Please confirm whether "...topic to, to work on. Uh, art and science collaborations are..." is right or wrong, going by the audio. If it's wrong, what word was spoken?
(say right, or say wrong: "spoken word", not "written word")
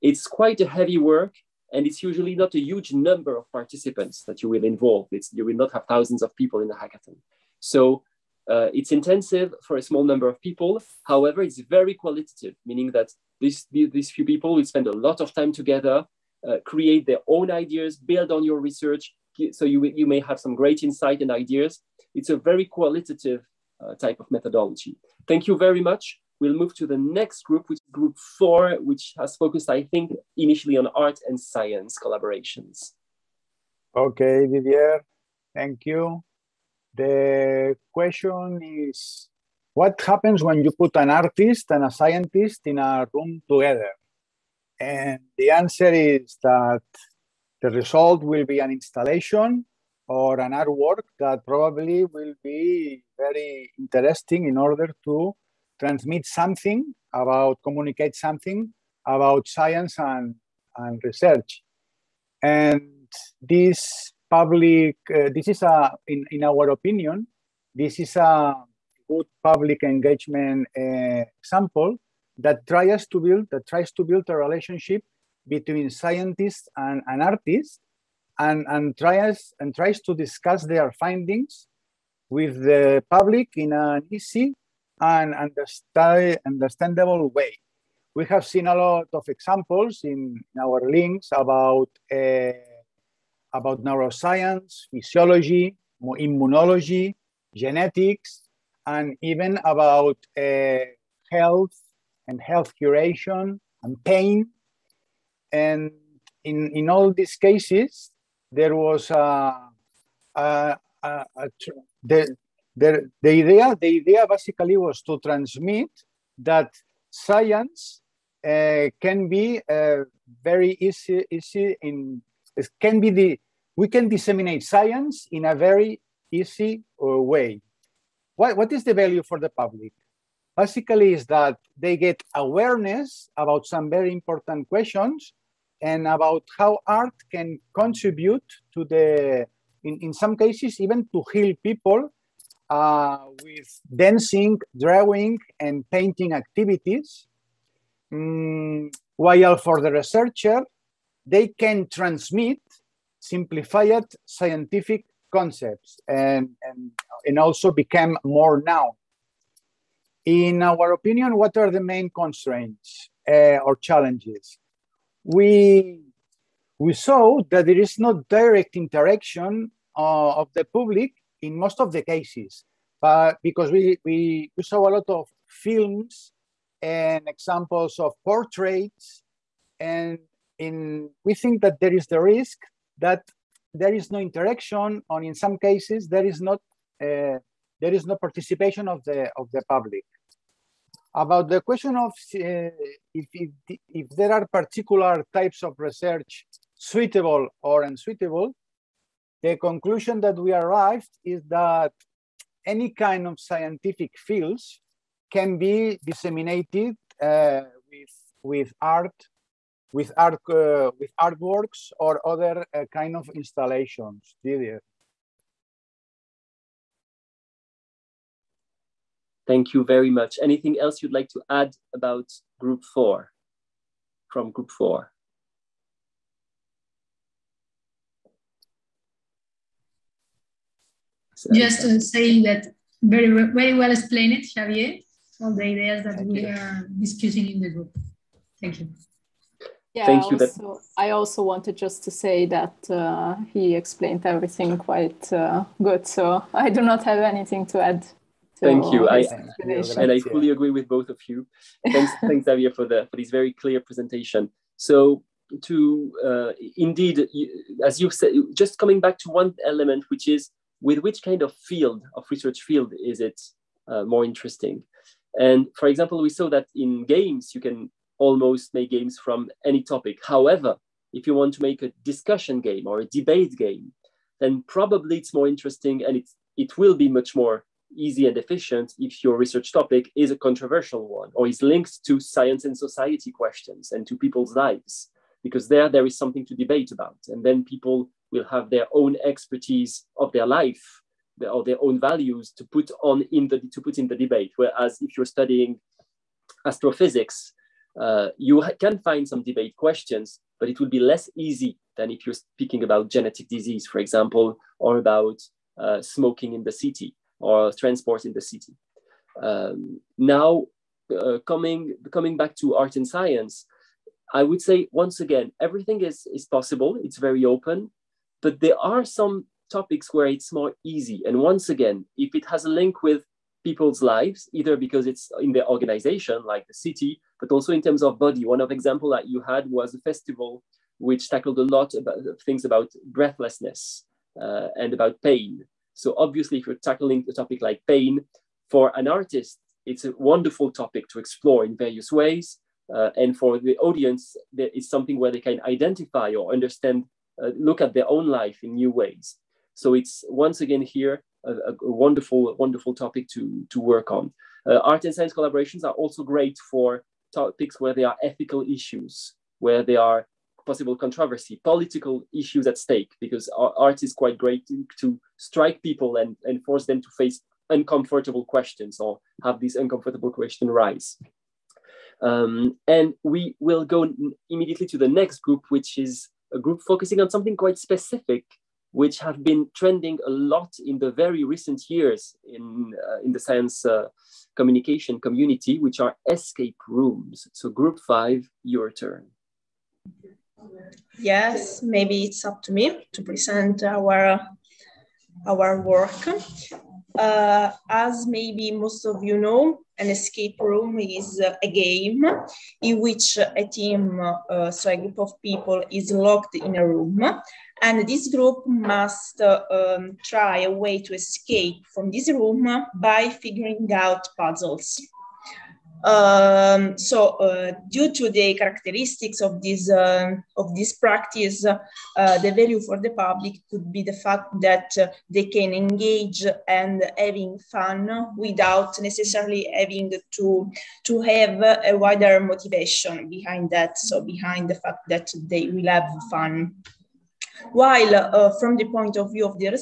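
right.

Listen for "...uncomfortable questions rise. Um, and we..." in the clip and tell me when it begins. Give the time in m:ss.
6:09.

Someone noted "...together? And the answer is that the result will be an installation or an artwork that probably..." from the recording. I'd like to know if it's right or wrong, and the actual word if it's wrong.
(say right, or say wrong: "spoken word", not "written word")
right.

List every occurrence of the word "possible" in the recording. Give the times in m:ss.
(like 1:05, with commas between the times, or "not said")
5:16, 6:00.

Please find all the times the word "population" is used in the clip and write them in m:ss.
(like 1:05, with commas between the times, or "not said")
not said.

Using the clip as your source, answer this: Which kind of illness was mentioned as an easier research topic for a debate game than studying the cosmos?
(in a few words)
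Genetic disease.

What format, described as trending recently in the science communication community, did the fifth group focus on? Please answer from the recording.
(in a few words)
Escape rooms.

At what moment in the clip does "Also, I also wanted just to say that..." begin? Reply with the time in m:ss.
4:00.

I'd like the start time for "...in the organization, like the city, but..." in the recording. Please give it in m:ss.
5:25.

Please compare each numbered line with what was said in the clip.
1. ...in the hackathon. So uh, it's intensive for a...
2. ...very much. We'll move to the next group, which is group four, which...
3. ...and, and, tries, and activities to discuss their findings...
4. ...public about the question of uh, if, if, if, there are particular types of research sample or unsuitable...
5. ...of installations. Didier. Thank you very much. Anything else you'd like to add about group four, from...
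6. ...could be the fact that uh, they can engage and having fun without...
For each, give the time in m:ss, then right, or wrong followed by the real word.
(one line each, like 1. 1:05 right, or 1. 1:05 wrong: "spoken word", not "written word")
1. 0:06 right
2. 0:25 right
3. 1:18 wrong: "tries", not "activities"
4. 3:09 wrong: "suitable", not "sample"
5. 3:33 right
6. 7:03 right.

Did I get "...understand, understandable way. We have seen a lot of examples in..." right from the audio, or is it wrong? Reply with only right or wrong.
right.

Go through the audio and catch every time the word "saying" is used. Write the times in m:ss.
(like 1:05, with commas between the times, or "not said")
3:51.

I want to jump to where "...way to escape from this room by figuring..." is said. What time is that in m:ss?
6:50.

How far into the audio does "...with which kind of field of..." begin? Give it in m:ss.
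4:20.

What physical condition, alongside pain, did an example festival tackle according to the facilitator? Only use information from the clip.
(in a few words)
Breathlessness.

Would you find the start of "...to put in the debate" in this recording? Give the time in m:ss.
4:53.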